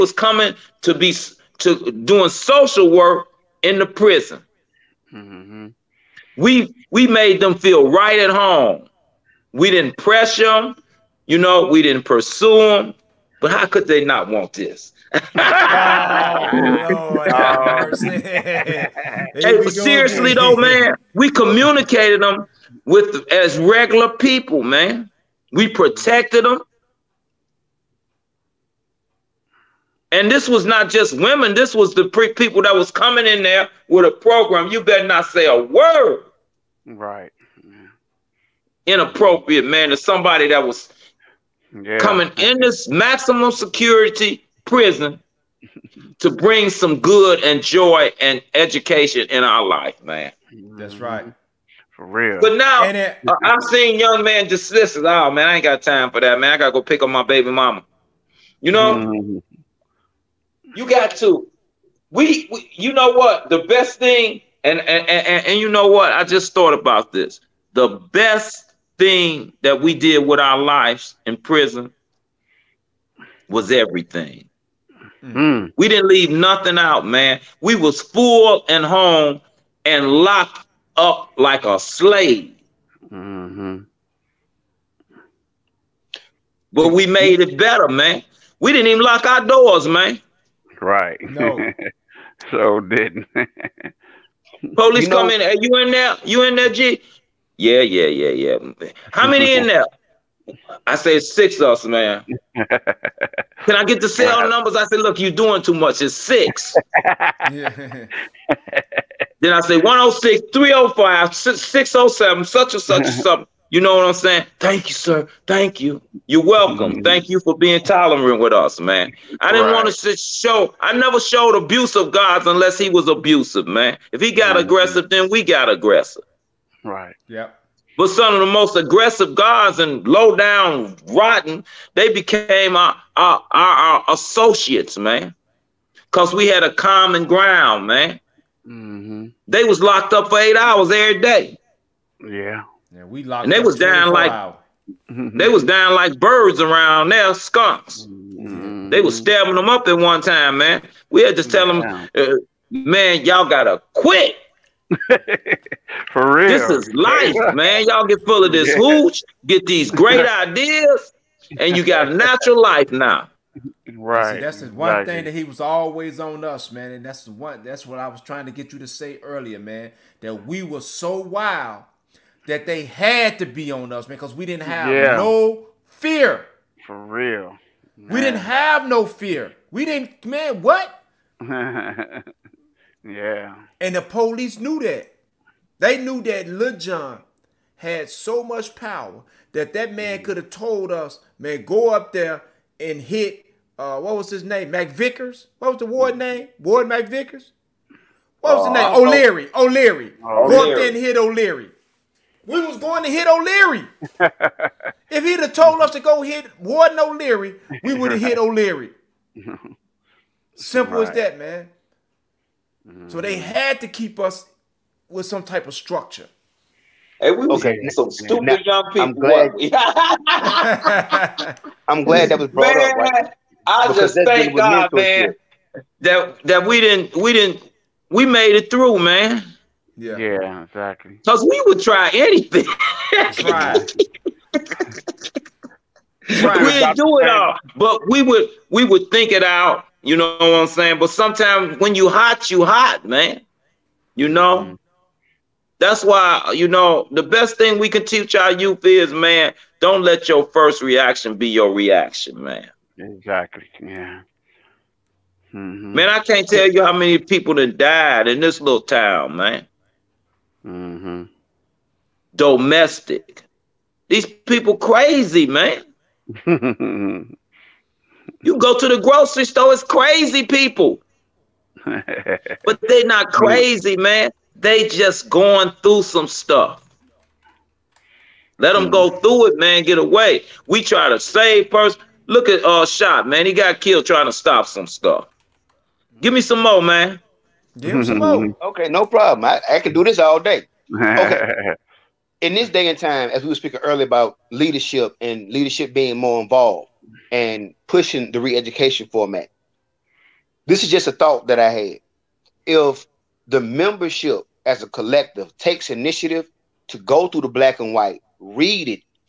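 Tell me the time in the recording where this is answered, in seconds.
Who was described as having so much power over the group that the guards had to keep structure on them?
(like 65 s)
186 s.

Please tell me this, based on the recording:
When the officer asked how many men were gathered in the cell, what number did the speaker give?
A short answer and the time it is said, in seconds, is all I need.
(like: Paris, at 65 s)
6, at 101 s.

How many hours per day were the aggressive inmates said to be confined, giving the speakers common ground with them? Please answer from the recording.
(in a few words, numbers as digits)
8.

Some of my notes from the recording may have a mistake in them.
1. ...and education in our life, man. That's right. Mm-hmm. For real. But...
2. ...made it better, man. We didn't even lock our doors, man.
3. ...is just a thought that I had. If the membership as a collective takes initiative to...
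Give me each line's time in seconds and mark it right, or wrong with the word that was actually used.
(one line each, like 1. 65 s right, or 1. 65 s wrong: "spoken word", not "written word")
1. 48 s right
2. 87 s right
3. 300 s right.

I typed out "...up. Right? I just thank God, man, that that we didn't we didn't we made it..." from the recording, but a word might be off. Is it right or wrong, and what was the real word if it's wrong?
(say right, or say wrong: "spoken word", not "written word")
right.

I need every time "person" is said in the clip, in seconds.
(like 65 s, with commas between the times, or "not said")
281 s.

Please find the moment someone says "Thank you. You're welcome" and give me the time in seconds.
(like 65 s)
115 s.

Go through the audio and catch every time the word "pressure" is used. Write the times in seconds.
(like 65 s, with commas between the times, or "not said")
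9 s.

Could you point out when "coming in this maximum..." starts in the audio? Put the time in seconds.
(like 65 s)
41 s.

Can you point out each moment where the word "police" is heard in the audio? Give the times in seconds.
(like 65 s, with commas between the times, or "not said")
94 s, 184 s.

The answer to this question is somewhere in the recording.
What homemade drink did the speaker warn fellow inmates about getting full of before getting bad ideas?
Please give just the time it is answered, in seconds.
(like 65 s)
158 s.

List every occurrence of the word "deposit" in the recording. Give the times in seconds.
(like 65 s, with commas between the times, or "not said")
not said.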